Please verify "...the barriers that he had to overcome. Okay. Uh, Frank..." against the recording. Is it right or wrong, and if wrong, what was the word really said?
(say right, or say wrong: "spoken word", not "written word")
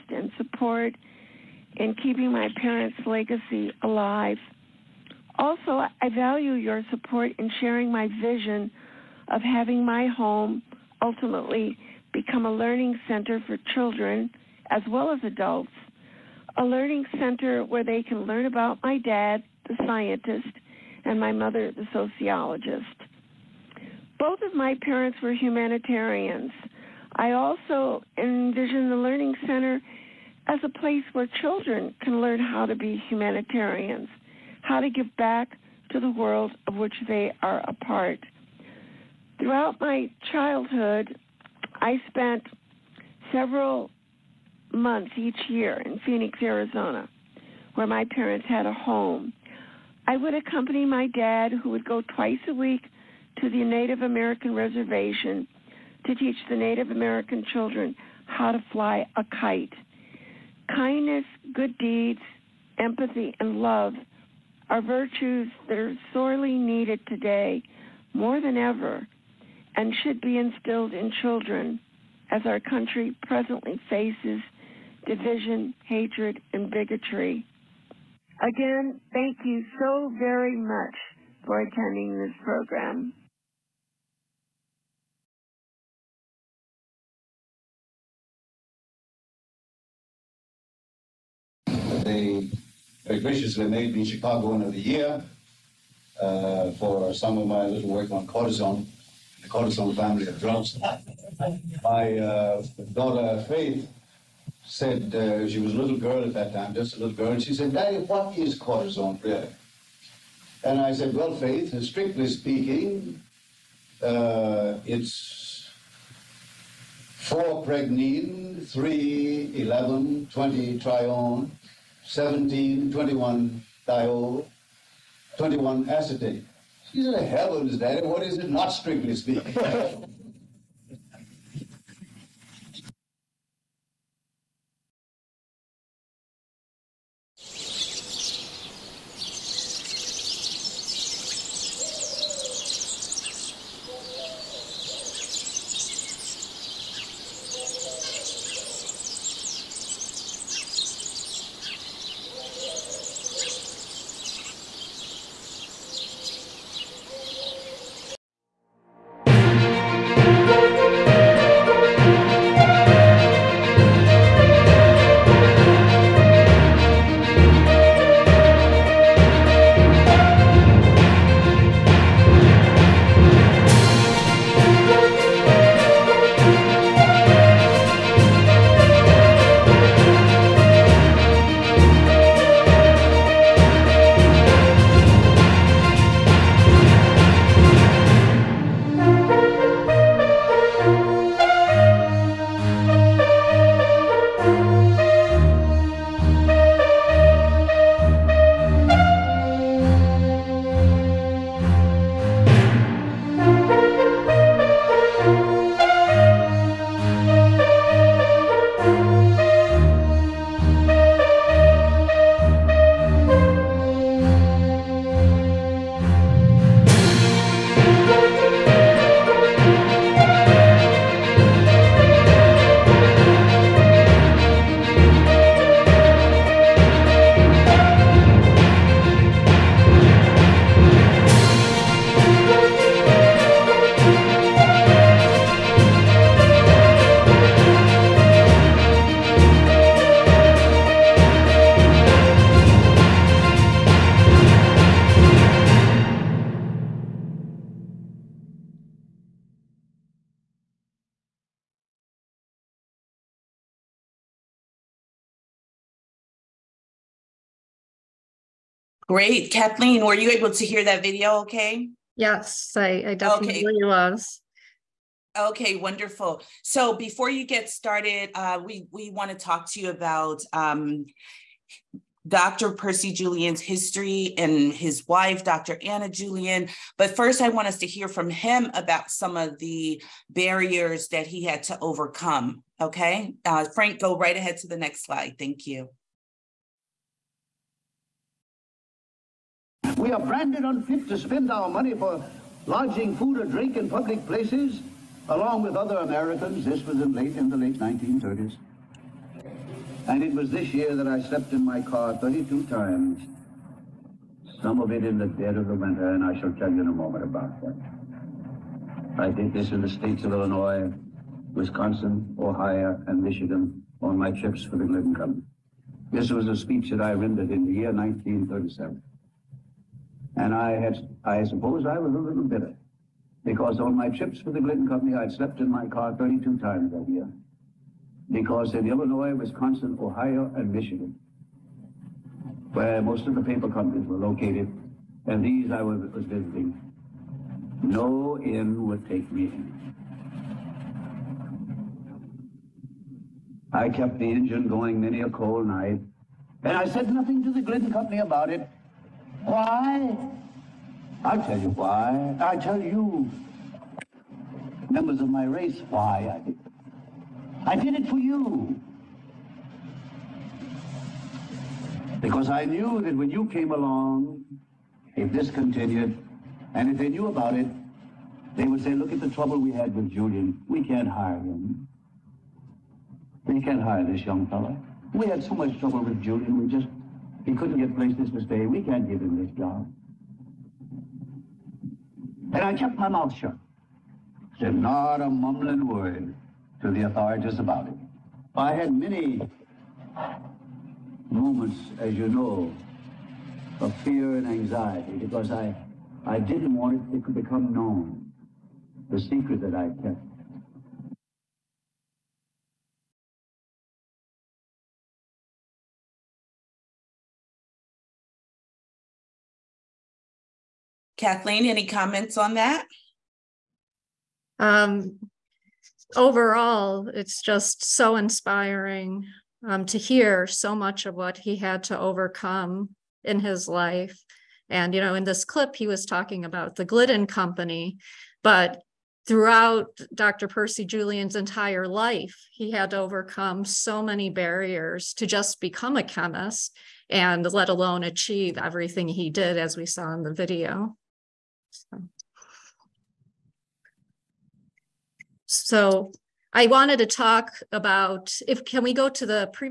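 right.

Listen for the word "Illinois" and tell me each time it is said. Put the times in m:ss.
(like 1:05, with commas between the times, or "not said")
5:10, 5:28.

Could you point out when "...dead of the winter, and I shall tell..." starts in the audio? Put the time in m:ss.
5:05.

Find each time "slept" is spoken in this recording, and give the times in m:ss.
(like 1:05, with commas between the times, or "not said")
5:01, 5:25.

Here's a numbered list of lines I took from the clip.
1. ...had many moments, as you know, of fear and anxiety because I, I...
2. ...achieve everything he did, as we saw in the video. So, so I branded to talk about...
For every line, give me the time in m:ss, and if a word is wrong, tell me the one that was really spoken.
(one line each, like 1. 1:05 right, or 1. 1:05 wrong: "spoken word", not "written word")
1. 6:28 right
2. 7:18 wrong: "wanted", not "branded".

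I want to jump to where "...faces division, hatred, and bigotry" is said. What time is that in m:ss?
1:13.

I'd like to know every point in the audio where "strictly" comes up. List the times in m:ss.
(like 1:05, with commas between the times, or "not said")
1:51, 2:08.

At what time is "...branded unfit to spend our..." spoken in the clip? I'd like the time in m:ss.
4:50.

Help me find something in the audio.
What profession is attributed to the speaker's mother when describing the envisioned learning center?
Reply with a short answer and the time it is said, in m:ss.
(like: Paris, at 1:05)
Sociologist, at 0:21.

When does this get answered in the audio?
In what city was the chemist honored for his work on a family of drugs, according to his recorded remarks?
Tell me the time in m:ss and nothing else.
1:34.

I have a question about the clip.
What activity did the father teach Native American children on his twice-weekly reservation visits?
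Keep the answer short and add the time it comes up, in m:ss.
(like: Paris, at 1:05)
How to fly a kite, at 0:58.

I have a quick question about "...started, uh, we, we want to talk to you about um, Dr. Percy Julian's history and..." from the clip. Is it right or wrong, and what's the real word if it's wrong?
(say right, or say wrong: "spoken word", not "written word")
right.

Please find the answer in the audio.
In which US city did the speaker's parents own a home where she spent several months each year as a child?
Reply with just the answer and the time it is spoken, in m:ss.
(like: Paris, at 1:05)
Phoenix, Arizona, at 0:46.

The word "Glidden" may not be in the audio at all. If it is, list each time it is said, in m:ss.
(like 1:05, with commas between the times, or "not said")
5:24, 5:47, 7:06.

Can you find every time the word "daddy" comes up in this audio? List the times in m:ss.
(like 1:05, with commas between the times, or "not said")
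1:47, 2:07.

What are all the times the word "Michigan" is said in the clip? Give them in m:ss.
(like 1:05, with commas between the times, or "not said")
5:13, 5:30.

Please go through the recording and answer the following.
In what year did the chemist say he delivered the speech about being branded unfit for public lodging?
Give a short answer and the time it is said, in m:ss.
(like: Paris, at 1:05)
1937, at 5:17.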